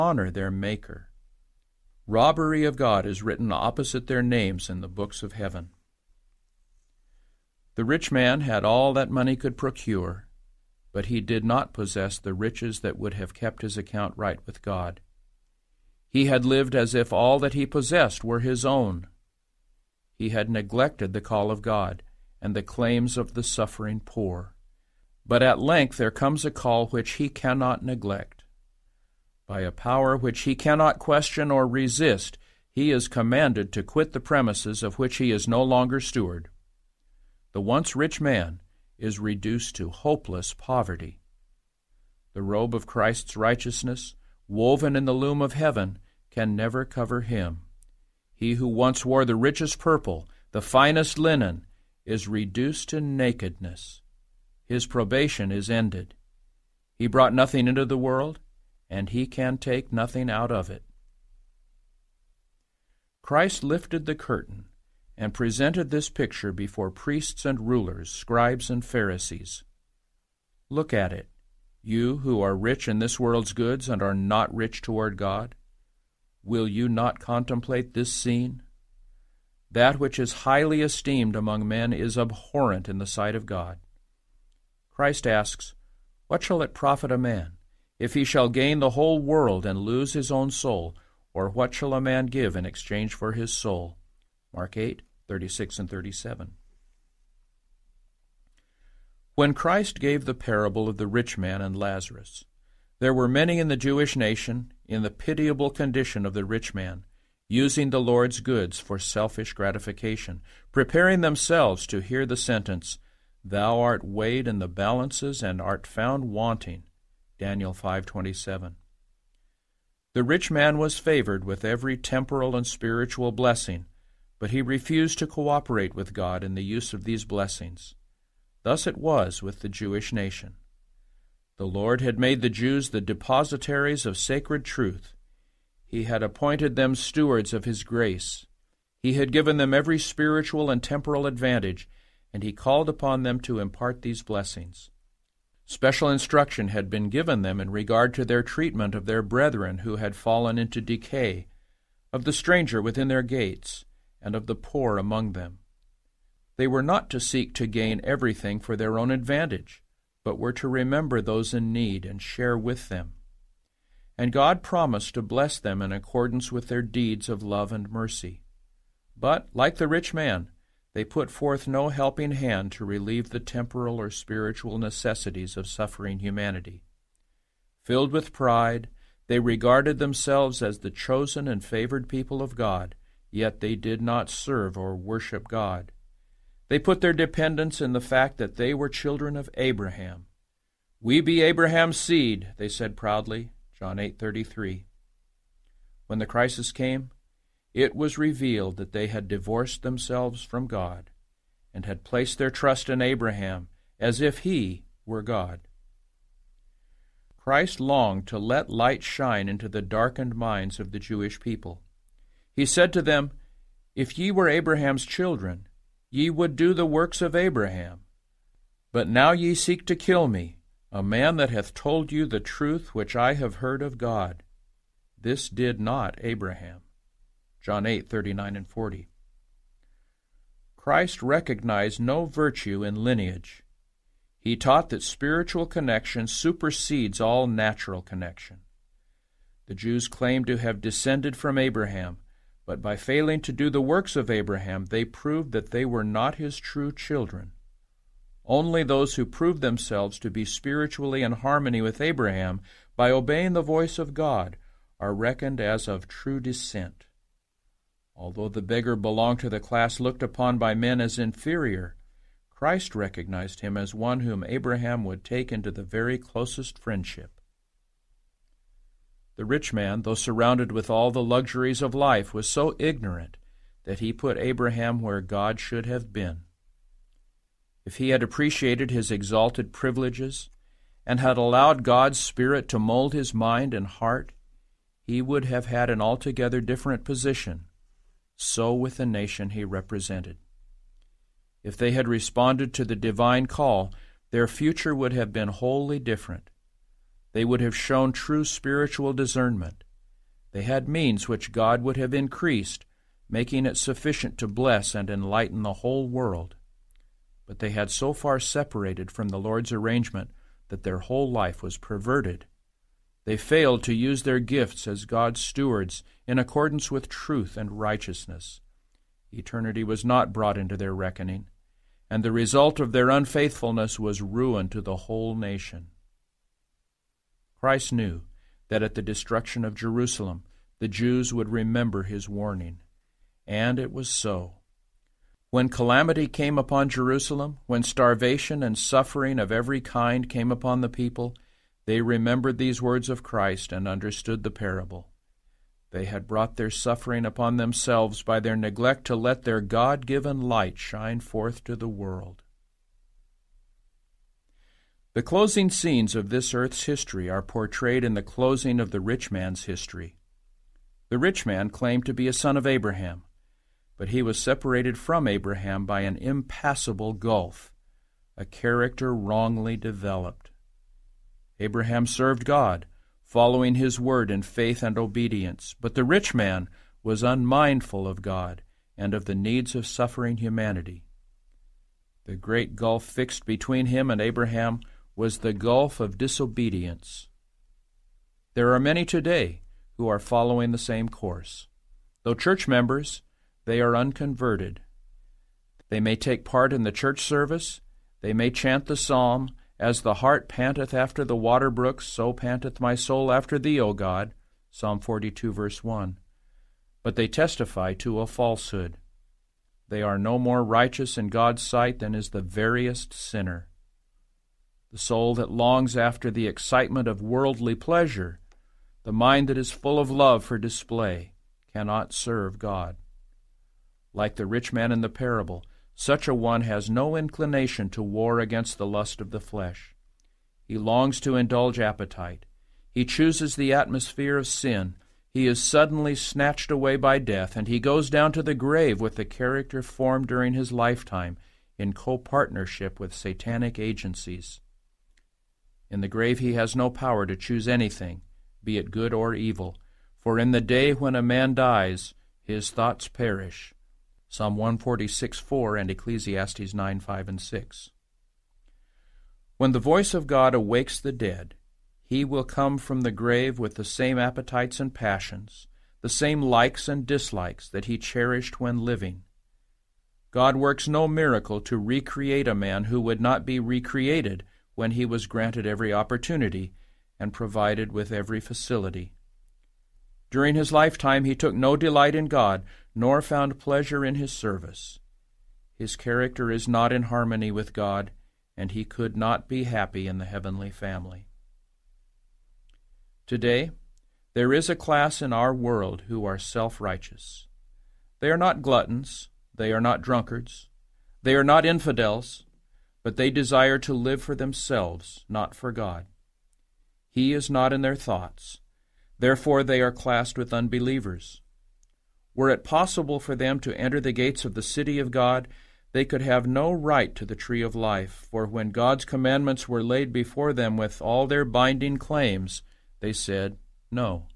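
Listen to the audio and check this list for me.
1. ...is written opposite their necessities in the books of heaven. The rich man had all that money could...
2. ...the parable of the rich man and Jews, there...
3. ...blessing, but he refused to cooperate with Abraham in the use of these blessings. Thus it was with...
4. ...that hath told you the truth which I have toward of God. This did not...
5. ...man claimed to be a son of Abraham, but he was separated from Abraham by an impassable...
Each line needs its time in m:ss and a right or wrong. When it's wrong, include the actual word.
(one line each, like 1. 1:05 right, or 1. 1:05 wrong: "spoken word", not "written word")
1. 0:03 wrong: "names", not "necessities"
2. 1:40 wrong: "Lazarus", not "Jews"
3. 2:03 wrong: "God", not "Abraham"
4. 3:41 wrong: "heard", not "toward"
5. 6:01 right.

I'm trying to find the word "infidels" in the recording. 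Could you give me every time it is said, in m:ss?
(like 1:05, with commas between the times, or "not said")
8:21.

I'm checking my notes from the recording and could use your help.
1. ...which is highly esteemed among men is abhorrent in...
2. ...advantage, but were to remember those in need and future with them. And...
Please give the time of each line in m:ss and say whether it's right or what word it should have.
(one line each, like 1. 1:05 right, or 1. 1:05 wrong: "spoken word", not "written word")
1. 1:19 right
2. 2:39 wrong: "share", not "future".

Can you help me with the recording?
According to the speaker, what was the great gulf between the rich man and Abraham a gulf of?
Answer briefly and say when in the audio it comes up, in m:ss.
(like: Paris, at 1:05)
disobedience, at 6:26.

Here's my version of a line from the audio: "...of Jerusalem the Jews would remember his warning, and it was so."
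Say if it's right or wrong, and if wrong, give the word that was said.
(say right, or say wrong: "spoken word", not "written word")
right.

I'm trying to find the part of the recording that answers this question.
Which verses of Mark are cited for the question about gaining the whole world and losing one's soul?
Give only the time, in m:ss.
1:35.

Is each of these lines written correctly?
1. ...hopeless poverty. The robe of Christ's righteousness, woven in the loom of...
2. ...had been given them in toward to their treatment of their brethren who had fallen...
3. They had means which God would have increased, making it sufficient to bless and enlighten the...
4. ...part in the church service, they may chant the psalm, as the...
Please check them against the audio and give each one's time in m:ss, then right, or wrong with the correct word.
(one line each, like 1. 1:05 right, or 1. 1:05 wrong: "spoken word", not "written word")
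1. 0:39 right
2. 2:26 wrong: "regard", not "toward"
3. 5:00 right
4. 6:36 right.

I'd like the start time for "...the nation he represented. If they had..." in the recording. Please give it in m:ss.
4:48.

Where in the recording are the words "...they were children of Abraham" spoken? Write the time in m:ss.
3:08.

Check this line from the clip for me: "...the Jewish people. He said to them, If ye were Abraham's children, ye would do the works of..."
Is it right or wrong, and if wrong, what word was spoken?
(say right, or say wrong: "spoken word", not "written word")
right.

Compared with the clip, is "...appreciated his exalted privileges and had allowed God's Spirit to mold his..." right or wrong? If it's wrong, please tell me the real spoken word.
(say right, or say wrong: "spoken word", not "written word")
right.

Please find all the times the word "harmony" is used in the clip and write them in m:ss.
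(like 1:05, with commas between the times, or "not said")
4:11, 8:07.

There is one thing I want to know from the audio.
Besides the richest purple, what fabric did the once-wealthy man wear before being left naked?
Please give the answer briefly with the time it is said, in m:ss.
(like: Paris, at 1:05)
finest linen, at 0:50.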